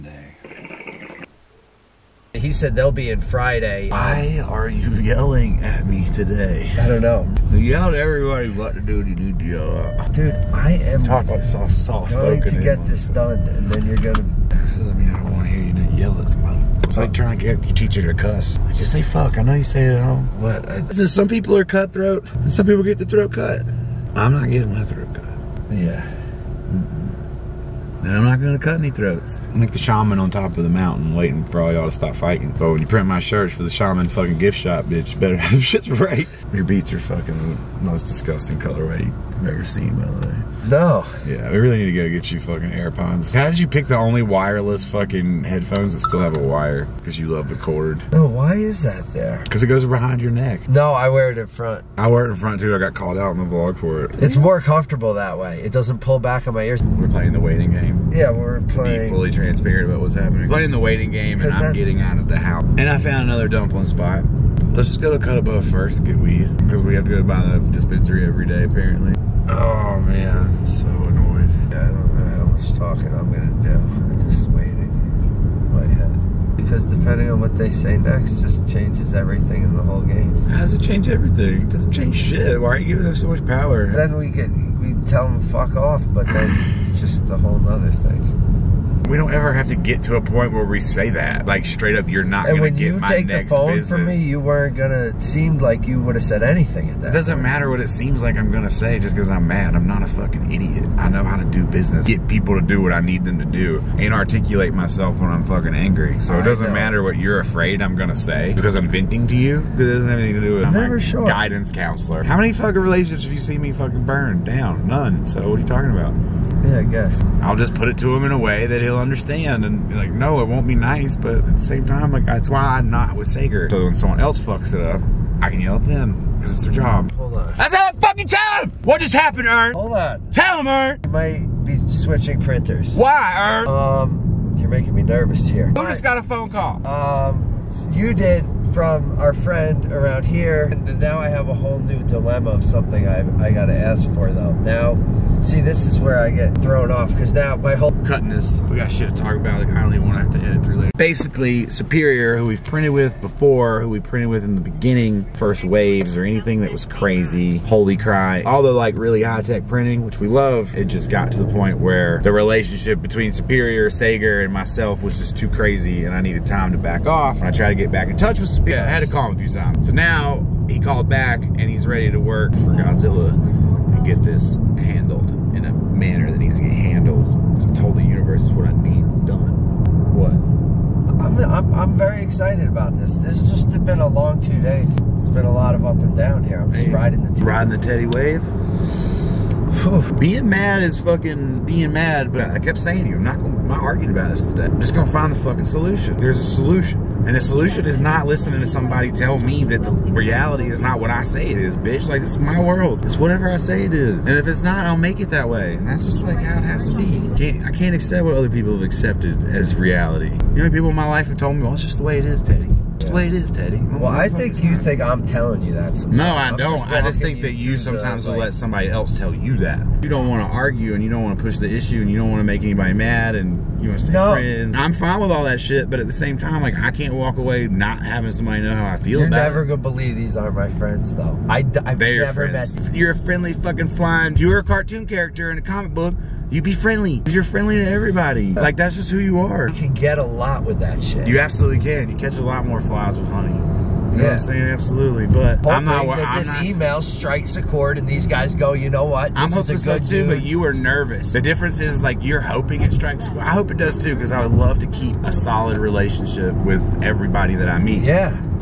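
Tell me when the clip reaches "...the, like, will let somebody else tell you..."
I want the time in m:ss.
3:38.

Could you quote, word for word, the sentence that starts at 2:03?
So when someone else fucks it up, I can yell at them because it's their job.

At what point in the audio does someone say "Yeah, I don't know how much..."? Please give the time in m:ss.
1:11.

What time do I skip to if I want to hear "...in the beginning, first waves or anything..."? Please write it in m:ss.
2:34.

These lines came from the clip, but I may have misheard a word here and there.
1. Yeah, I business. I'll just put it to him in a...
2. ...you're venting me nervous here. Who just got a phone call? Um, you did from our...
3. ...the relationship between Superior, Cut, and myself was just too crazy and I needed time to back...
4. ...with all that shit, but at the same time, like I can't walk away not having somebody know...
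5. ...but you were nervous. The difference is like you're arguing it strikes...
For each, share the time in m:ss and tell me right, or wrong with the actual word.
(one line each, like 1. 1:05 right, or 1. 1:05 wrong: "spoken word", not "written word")
1. 1:56 wrong: "guess", not "business"
2. 2:14 wrong: "making", not "venting"
3. 2:42 wrong: "Sager", not "Cut"
4. 3:45 right
5. 4:10 wrong: "hoping", not "arguing".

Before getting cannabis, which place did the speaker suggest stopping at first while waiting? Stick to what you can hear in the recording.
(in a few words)
Cut Above.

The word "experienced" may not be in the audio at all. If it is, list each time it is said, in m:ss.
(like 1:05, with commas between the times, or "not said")
not said.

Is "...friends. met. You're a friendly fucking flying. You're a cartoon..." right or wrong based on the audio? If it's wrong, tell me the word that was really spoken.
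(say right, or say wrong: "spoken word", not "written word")
right.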